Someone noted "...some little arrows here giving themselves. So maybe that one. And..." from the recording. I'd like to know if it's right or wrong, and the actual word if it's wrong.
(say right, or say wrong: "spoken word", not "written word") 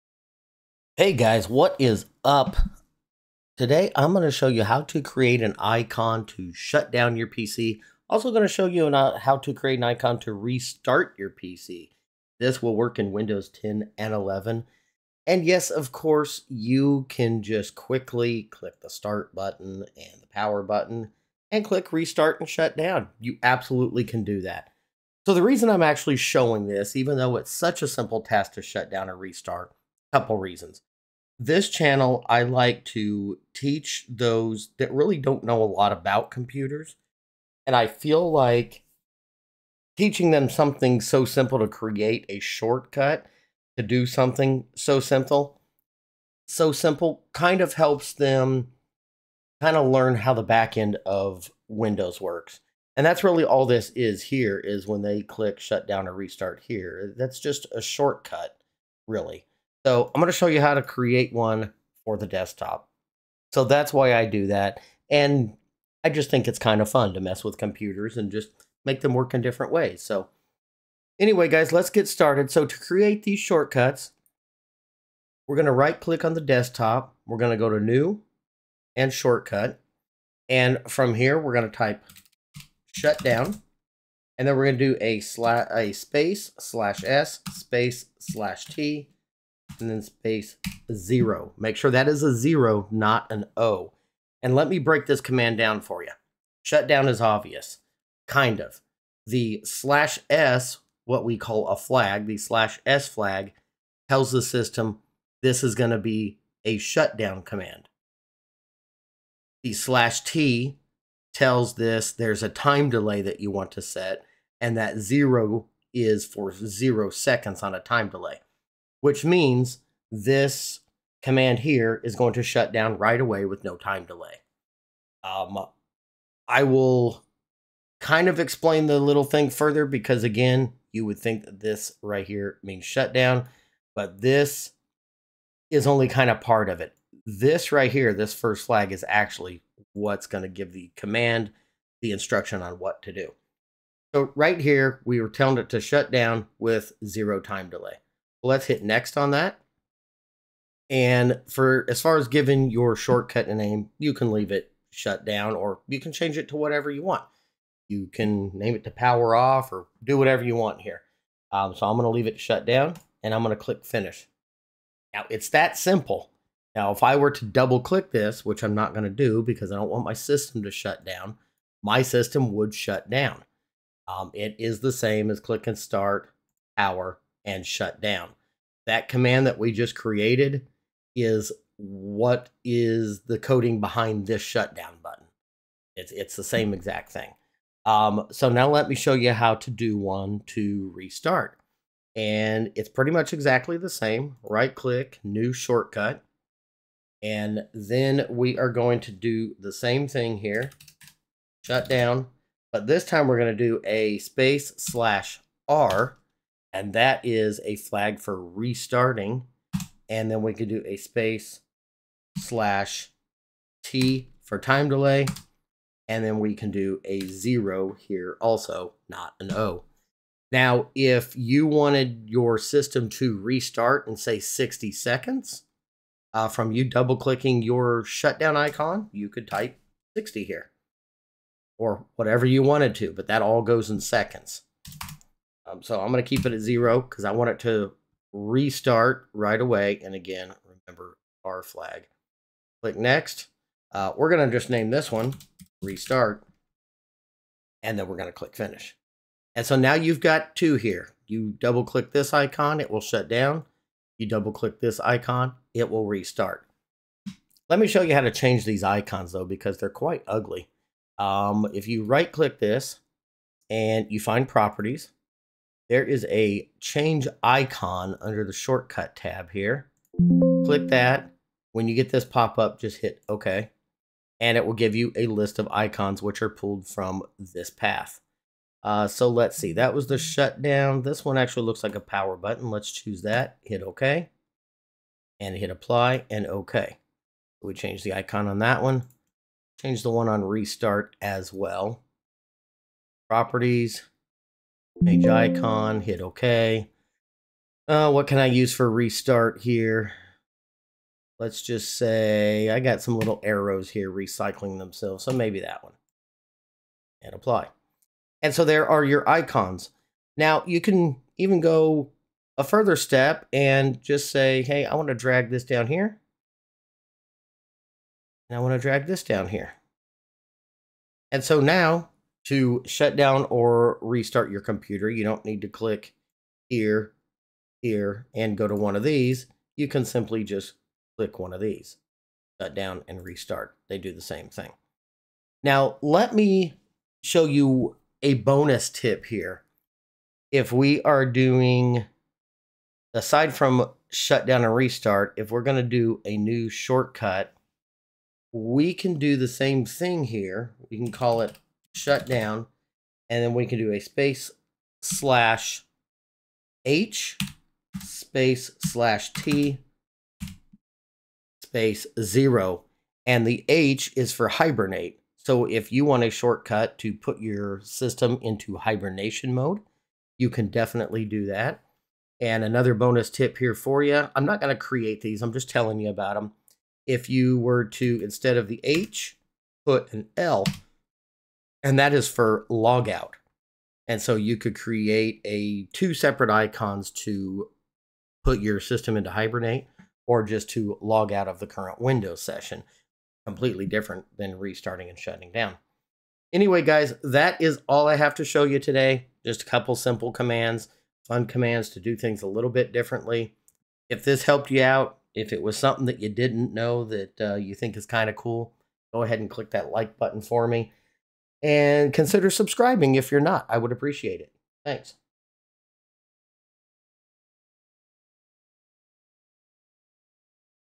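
wrong: "recycling", not "giving".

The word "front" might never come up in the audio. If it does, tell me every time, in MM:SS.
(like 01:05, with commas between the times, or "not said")
not said.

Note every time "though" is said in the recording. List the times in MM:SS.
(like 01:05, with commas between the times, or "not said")
00:27, 04:19.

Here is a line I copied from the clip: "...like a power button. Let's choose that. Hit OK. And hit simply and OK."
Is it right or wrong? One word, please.
wrong.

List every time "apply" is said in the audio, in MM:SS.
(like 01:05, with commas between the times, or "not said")
04:45, 05:07.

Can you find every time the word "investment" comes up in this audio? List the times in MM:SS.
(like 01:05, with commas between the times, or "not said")
not said.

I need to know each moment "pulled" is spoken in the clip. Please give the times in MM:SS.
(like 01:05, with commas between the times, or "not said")
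04:36.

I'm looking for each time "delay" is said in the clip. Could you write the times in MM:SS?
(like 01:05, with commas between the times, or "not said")
01:52, 01:58, 02:04, 02:27, 03:34.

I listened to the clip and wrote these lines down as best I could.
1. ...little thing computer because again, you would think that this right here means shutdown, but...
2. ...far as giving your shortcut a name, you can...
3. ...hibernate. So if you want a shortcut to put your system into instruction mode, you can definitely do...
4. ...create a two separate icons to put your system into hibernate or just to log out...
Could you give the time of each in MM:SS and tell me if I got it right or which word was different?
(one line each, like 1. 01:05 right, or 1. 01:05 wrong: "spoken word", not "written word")
1. 02:08 wrong: "further", not "computer"
2. 02:32 right
3. 06:04 wrong: "hibernation", not "instruction"
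4. 06:24 right.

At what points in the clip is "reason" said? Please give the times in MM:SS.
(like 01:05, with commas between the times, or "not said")
00:25, 00:30.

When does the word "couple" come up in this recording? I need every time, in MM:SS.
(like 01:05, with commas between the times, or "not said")
00:30, 06:39.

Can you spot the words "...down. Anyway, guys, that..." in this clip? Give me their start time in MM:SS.
06:35.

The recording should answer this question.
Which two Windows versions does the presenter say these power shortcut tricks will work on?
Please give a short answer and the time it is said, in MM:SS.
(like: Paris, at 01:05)
Windows 10 and 11, at 00:13.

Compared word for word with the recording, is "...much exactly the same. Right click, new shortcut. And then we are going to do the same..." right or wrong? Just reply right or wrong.
right.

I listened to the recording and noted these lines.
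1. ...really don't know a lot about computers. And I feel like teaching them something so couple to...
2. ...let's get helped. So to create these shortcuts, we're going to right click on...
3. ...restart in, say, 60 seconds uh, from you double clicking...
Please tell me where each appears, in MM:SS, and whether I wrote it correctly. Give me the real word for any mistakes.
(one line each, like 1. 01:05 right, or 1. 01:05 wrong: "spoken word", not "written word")
1. 00:34 wrong: "simple", not "couple"
2. 01:11 wrong: "started", not "helped"
3. 03:43 right.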